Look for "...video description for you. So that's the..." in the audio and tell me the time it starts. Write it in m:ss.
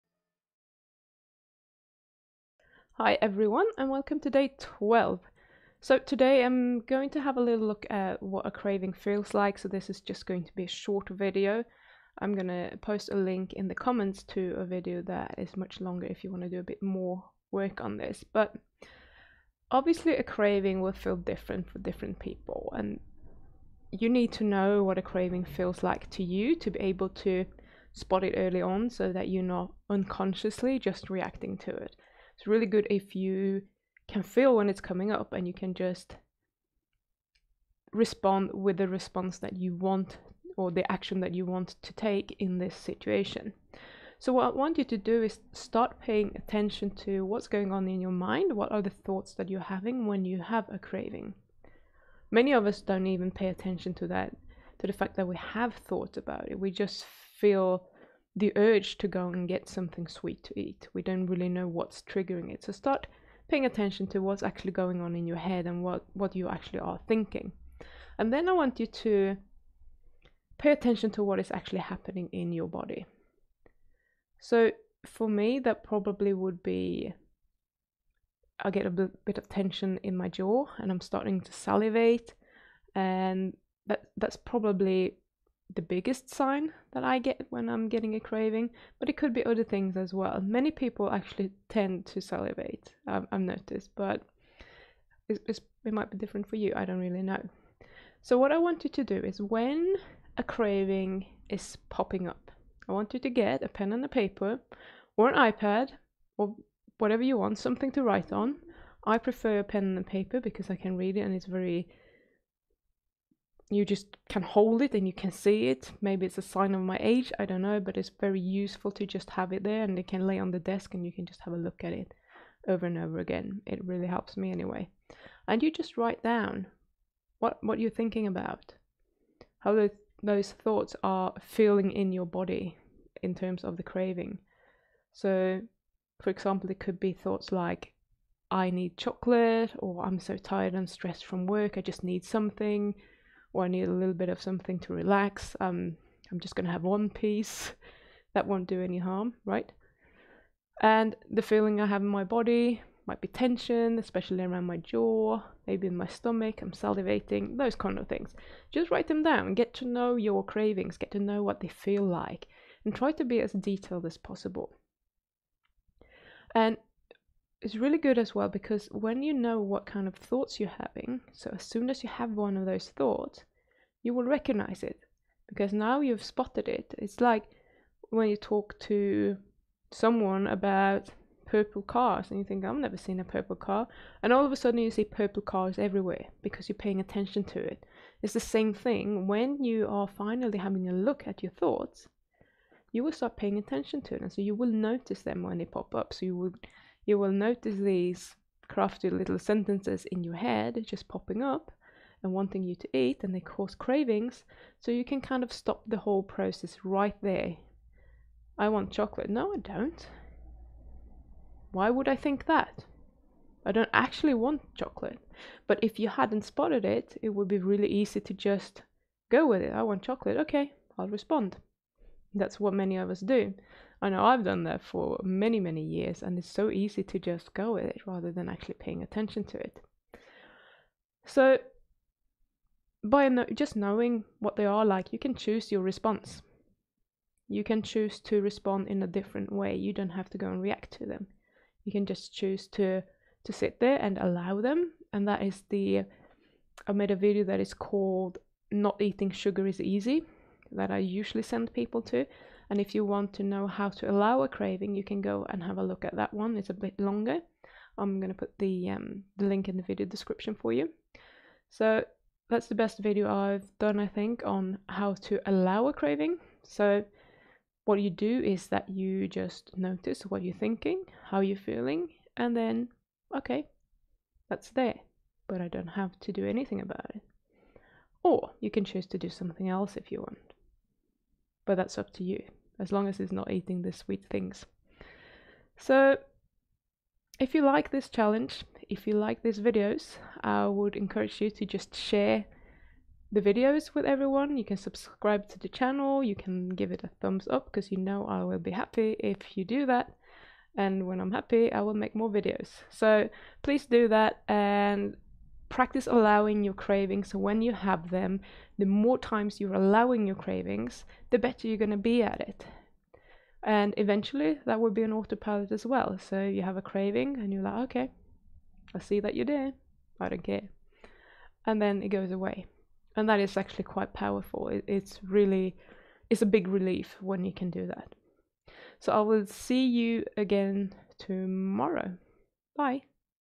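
4:19.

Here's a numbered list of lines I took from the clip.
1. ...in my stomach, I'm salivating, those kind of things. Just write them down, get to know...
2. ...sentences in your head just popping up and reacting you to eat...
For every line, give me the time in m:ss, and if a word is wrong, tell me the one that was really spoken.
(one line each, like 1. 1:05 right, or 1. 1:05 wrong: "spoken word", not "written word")
1. 2:35 right
2. 3:19 wrong: "wanting", not "reacting".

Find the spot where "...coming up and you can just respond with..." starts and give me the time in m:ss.
0:34.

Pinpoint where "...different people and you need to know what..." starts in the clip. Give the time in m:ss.
0:21.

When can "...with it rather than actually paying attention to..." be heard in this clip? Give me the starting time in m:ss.
3:47.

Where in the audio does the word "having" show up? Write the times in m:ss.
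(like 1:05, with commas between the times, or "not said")
0:49, 2:50, 3:10.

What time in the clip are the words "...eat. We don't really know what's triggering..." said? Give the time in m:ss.
1:00.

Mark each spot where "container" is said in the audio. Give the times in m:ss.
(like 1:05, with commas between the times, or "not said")
not said.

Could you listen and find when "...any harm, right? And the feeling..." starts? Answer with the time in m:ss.
2:28.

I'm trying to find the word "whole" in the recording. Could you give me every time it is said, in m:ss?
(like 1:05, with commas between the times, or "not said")
3:25.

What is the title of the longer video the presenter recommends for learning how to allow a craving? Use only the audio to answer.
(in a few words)
Not Eating Sugar Is Easy.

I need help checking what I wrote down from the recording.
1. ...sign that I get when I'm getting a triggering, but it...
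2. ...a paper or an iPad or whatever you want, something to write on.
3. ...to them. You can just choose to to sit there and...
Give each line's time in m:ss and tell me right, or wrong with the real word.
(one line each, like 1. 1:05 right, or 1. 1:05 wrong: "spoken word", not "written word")
1. 1:26 wrong: "craving", not "triggering"
2. 1:44 right
3. 4:00 right.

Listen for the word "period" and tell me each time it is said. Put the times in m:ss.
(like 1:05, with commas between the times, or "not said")
not said.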